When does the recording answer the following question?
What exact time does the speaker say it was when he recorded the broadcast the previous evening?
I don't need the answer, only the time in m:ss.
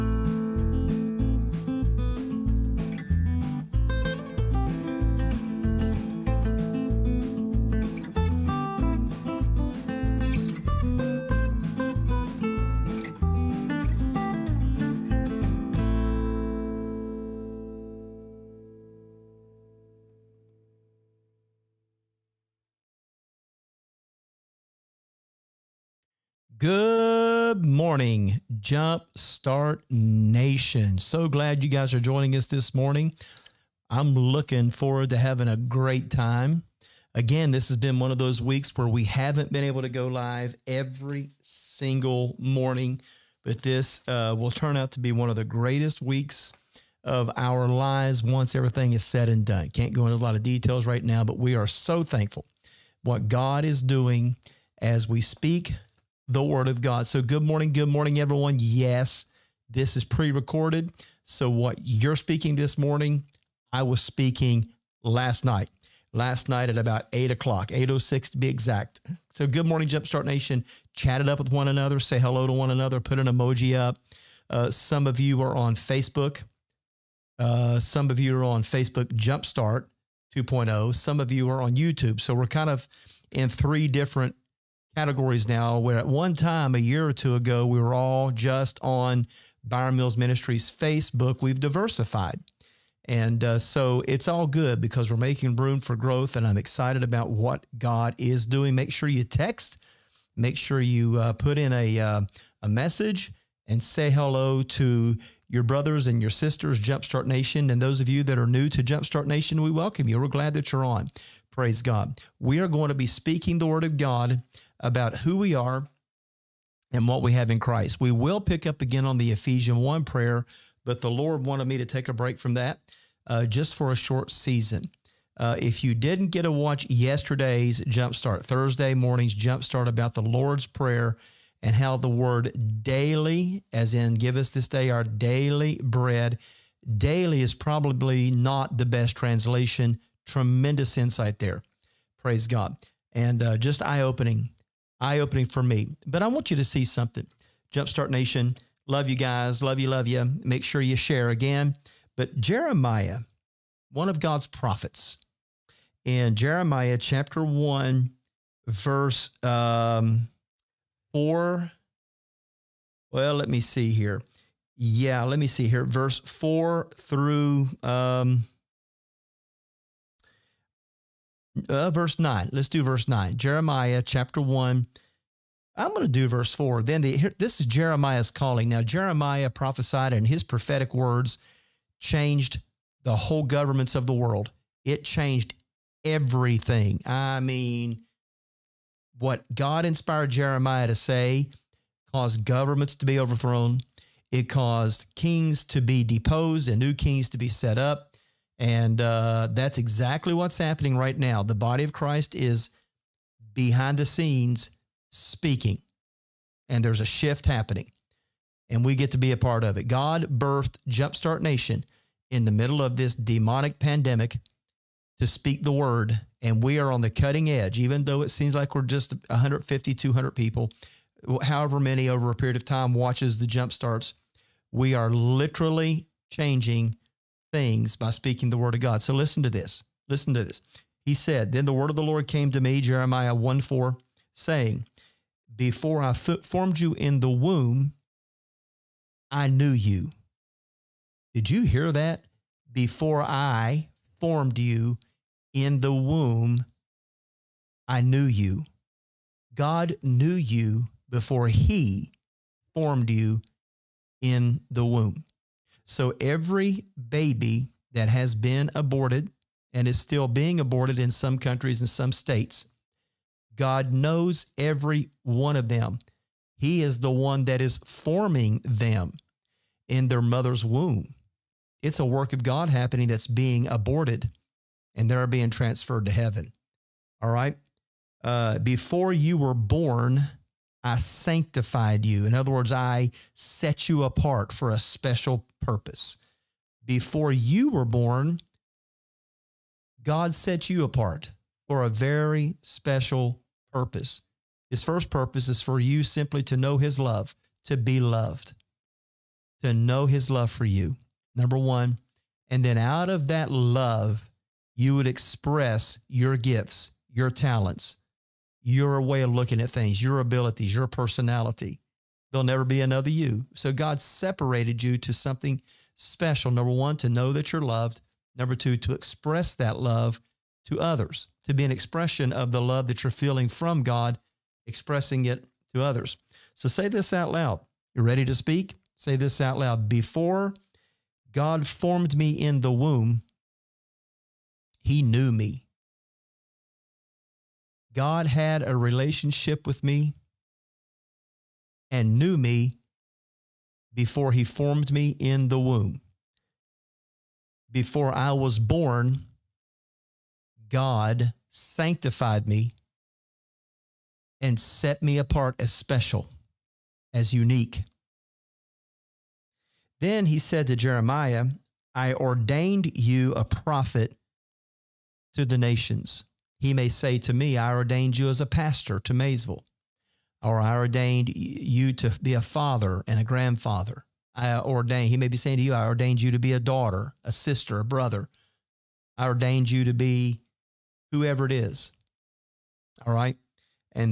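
1:07.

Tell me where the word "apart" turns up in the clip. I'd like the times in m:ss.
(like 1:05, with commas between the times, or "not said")
4:44, 4:50, 5:55.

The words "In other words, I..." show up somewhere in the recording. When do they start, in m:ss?
4:42.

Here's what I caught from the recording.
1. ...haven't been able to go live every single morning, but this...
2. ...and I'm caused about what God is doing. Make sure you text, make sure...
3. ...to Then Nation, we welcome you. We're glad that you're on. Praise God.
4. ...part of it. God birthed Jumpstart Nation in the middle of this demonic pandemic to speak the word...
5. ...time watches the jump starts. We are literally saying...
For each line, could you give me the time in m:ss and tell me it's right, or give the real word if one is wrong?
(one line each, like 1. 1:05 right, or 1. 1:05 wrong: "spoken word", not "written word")
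1. 0:39 right
2. 1:36 wrong: "excited", not "caused"
3. 1:48 wrong: "Jumpstart", not "Then"
4. 3:29 right
5. 3:42 wrong: "changing", not "saying".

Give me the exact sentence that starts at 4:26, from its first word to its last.
He is the one that is forming them in their mother's womb.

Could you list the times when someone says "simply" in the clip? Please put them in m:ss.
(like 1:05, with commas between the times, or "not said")
4:56.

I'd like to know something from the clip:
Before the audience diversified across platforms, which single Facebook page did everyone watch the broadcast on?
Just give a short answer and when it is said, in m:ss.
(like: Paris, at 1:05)
Byron Mills Ministries, at 1:29.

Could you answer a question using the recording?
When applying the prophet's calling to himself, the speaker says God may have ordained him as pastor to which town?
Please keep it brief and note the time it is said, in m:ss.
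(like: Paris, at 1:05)
Maysville, at 6:09.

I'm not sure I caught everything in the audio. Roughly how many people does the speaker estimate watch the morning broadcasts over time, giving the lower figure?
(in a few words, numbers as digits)
150.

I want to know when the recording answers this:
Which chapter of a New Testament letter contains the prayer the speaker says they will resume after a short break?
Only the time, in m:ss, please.
1:59.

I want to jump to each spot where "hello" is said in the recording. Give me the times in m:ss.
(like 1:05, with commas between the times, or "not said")
1:12, 1:44.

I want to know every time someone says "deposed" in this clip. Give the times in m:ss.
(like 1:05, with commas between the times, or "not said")
3:16.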